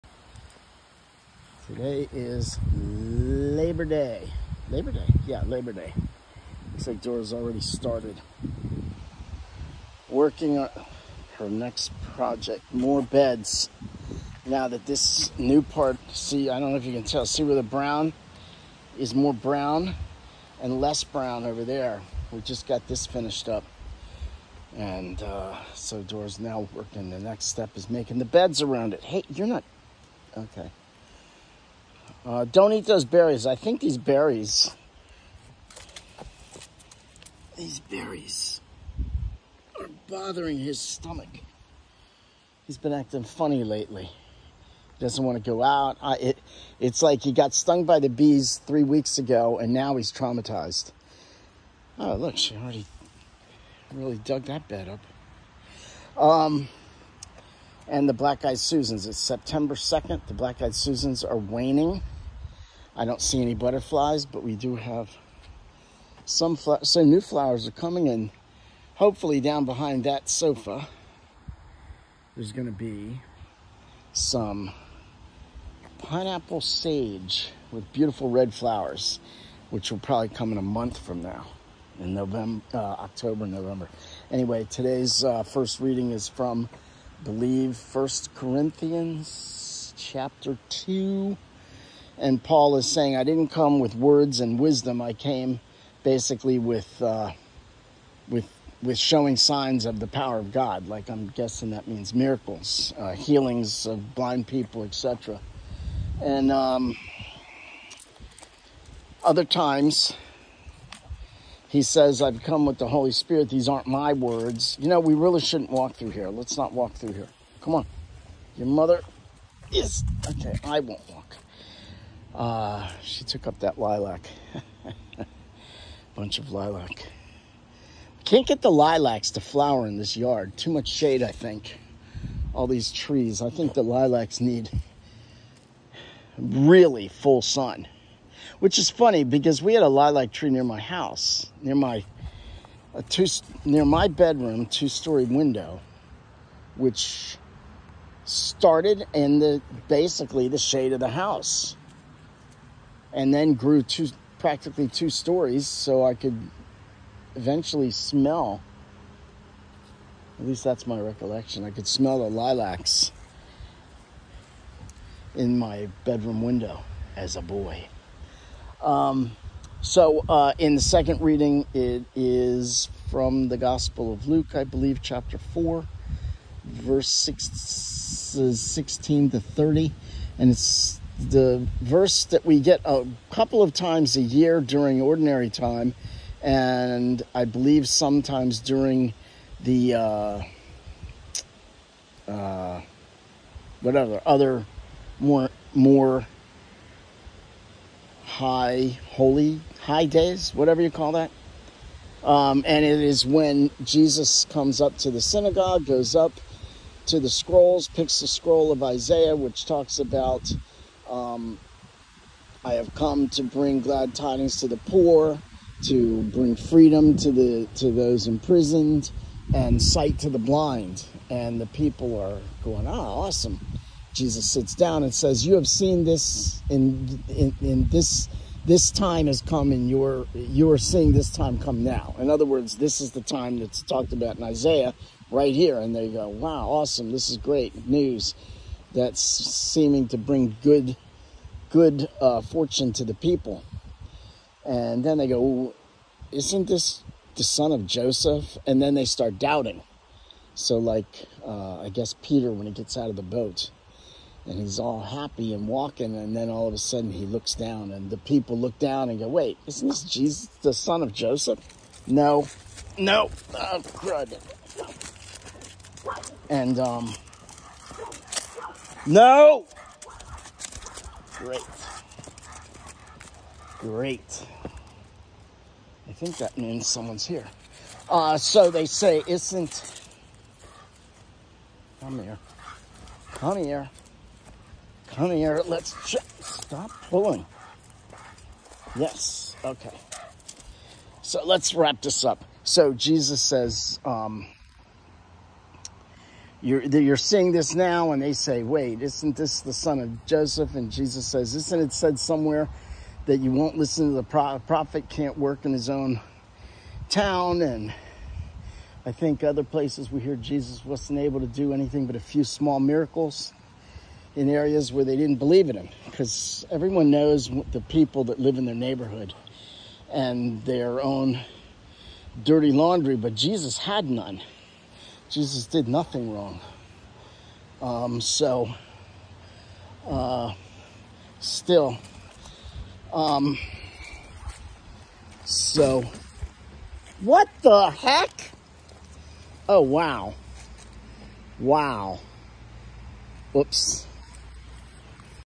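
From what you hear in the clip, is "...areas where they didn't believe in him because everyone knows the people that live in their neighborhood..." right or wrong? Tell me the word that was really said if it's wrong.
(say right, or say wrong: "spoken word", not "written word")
right.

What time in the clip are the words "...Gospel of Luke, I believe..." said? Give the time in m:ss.
2:53.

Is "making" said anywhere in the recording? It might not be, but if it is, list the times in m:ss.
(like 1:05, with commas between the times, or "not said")
0:27.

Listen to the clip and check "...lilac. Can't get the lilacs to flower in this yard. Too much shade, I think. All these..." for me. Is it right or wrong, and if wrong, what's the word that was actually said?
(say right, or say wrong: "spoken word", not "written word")
right.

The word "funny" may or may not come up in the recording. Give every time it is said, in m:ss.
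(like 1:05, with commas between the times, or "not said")
0:43, 2:18.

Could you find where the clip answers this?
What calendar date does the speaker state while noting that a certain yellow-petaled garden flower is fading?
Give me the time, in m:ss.
0:59.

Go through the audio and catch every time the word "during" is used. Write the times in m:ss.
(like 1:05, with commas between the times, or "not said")
3:04, 3:08.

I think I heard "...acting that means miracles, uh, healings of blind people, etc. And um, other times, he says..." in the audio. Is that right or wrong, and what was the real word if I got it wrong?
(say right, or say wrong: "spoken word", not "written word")
wrong: "guessing", not "acting".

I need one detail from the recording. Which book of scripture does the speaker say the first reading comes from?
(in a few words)
First Corinthians.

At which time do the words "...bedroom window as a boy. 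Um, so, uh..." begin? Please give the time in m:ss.
2:46.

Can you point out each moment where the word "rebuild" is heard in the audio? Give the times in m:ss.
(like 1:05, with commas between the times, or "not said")
not said.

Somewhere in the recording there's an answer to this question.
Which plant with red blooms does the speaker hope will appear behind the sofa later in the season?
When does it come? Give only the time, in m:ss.
1:15.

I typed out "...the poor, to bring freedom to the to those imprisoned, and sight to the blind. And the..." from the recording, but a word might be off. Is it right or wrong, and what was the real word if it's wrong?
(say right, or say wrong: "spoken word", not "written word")
right.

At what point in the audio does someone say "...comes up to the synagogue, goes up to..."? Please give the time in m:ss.
3:24.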